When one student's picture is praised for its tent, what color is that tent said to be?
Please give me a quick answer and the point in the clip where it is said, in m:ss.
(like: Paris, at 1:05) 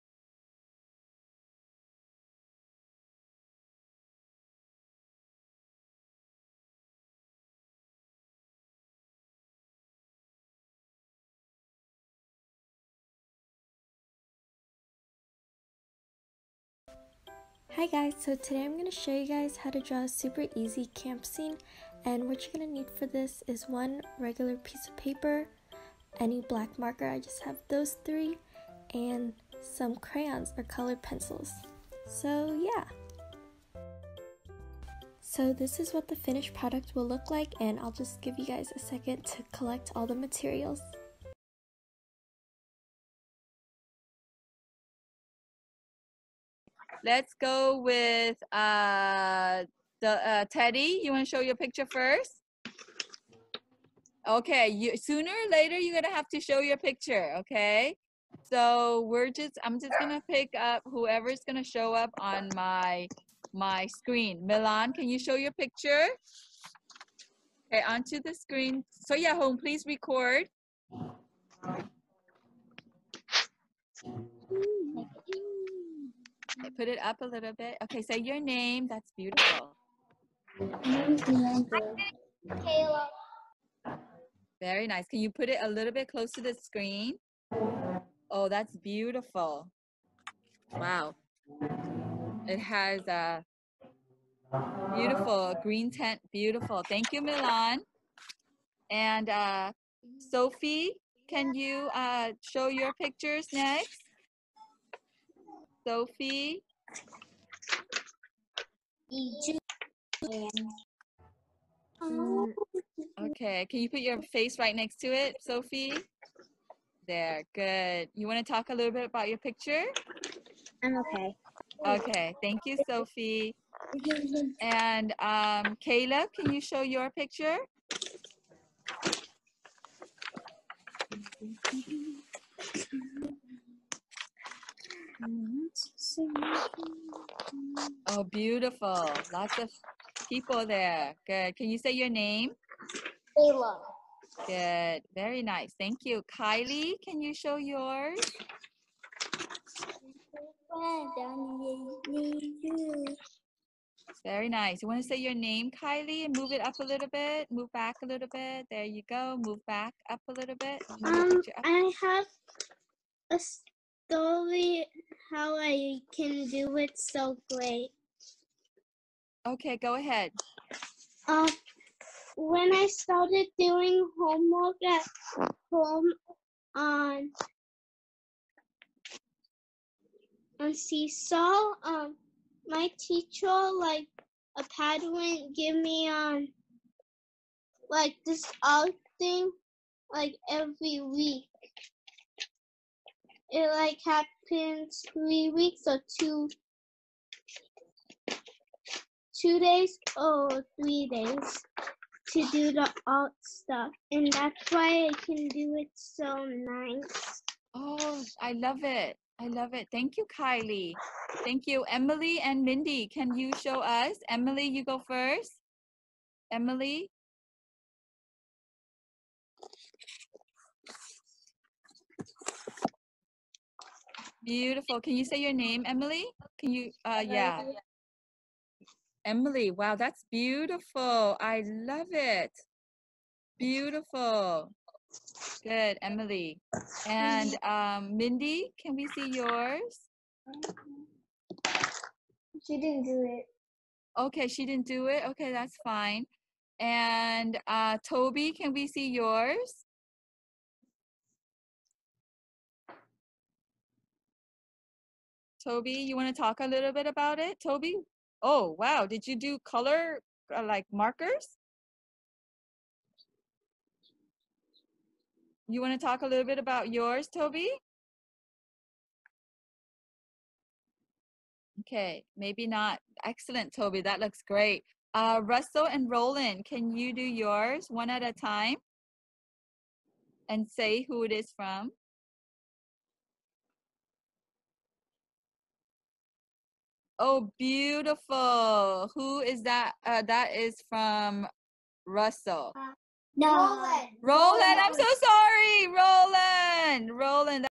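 green, at 1:35.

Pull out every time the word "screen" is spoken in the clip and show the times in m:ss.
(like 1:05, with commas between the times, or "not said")
1:03, 1:08, 1:26.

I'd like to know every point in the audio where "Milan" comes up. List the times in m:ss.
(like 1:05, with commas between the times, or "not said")
1:04, 1:37.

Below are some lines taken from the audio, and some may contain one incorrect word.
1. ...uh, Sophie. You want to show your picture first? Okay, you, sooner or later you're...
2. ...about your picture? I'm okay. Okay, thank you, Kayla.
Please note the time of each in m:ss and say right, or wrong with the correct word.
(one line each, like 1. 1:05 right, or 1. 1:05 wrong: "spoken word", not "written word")
1. 0:50 wrong: "Teddy", not "Sophie"
2. 1:59 wrong: "Sophie", not "Kayla".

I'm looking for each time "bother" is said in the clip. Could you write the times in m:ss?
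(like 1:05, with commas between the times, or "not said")
not said.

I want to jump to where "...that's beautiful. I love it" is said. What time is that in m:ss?
3:49.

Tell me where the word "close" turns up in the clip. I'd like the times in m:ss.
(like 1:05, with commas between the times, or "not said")
1:26.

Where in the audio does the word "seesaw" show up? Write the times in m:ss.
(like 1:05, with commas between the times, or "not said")
3:00.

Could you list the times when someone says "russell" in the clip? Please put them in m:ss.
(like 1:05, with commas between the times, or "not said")
4:35, 4:52.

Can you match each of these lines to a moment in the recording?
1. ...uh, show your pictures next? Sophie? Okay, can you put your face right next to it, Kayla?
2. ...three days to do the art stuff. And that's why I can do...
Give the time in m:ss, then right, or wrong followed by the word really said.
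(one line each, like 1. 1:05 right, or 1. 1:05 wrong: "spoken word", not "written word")
1. 1:41 wrong: "Sophie", not "Kayla"
2. 3:20 right.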